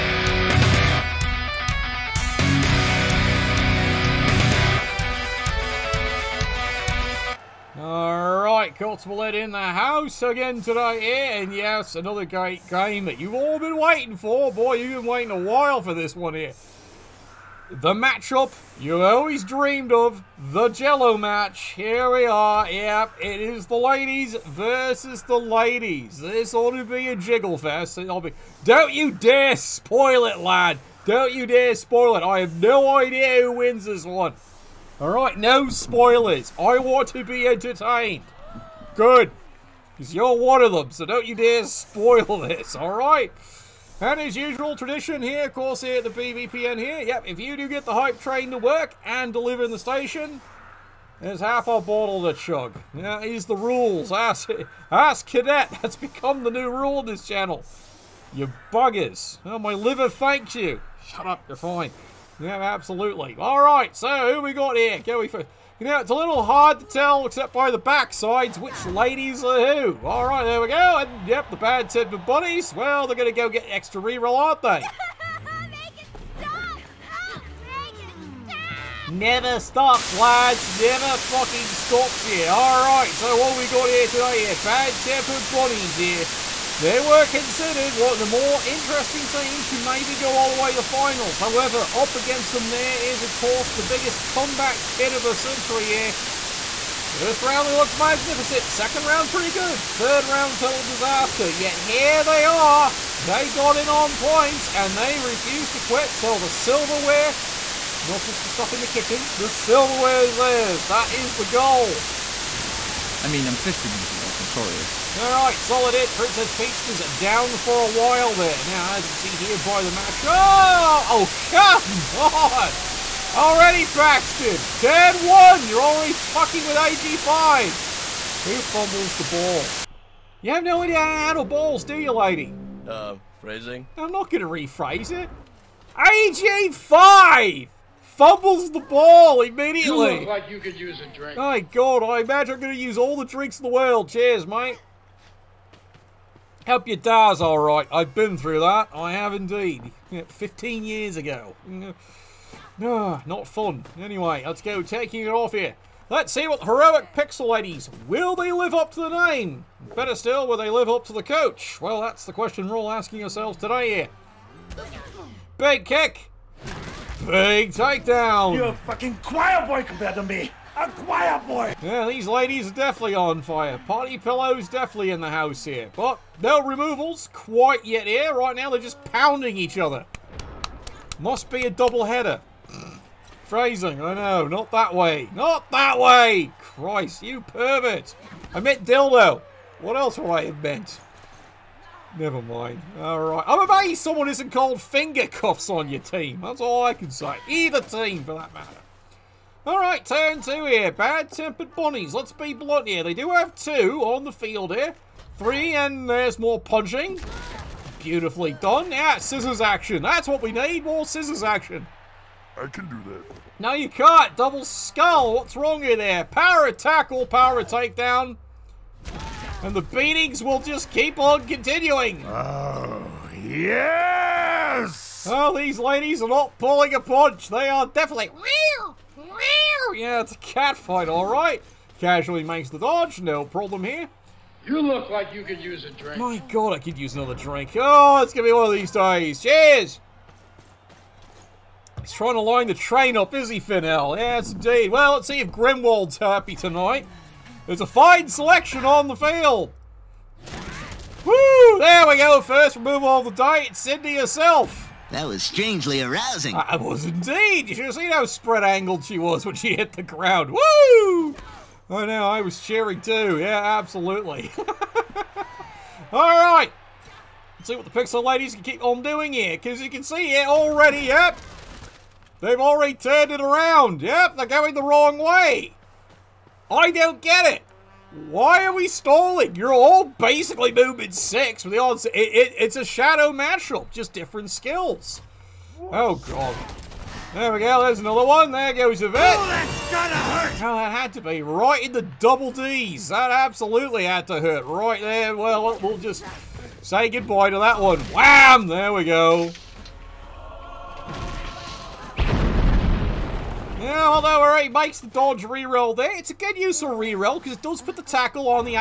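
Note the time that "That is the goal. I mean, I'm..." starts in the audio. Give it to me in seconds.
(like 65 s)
110 s.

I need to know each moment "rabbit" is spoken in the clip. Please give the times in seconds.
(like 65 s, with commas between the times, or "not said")
not said.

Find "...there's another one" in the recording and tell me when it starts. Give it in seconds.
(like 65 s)
287 s.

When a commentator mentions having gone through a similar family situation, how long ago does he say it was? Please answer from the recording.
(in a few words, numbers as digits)
15 years ago.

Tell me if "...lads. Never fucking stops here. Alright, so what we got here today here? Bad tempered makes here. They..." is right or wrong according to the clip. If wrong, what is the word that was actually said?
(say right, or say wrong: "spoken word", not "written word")
wrong: "bunnies", not "makes".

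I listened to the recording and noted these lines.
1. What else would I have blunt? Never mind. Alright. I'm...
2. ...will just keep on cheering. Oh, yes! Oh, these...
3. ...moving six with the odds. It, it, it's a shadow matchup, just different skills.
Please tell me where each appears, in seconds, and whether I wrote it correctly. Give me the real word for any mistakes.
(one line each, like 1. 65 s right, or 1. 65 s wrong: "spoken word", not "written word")
1. 189 s wrong: "meant", not "blunt"
2. 220 s wrong: "continuing", not "cheering"
3. 280 s right.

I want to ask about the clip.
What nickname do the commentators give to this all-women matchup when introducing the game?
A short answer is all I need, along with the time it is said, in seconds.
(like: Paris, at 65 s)
The Jello match, at 20 s.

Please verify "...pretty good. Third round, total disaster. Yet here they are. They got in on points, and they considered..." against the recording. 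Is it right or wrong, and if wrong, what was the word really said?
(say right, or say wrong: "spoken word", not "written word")
wrong: "refused", not "considered".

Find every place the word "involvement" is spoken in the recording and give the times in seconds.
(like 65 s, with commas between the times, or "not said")
not said.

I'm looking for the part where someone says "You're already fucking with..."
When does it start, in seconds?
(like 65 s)
125 s.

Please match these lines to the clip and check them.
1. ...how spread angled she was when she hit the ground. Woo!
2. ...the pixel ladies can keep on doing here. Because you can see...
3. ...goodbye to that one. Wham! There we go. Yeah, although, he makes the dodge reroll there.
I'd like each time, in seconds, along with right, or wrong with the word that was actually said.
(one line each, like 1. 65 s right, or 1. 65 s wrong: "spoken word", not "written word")
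1. 258 s right
2. 267 s right
3. 297 s right.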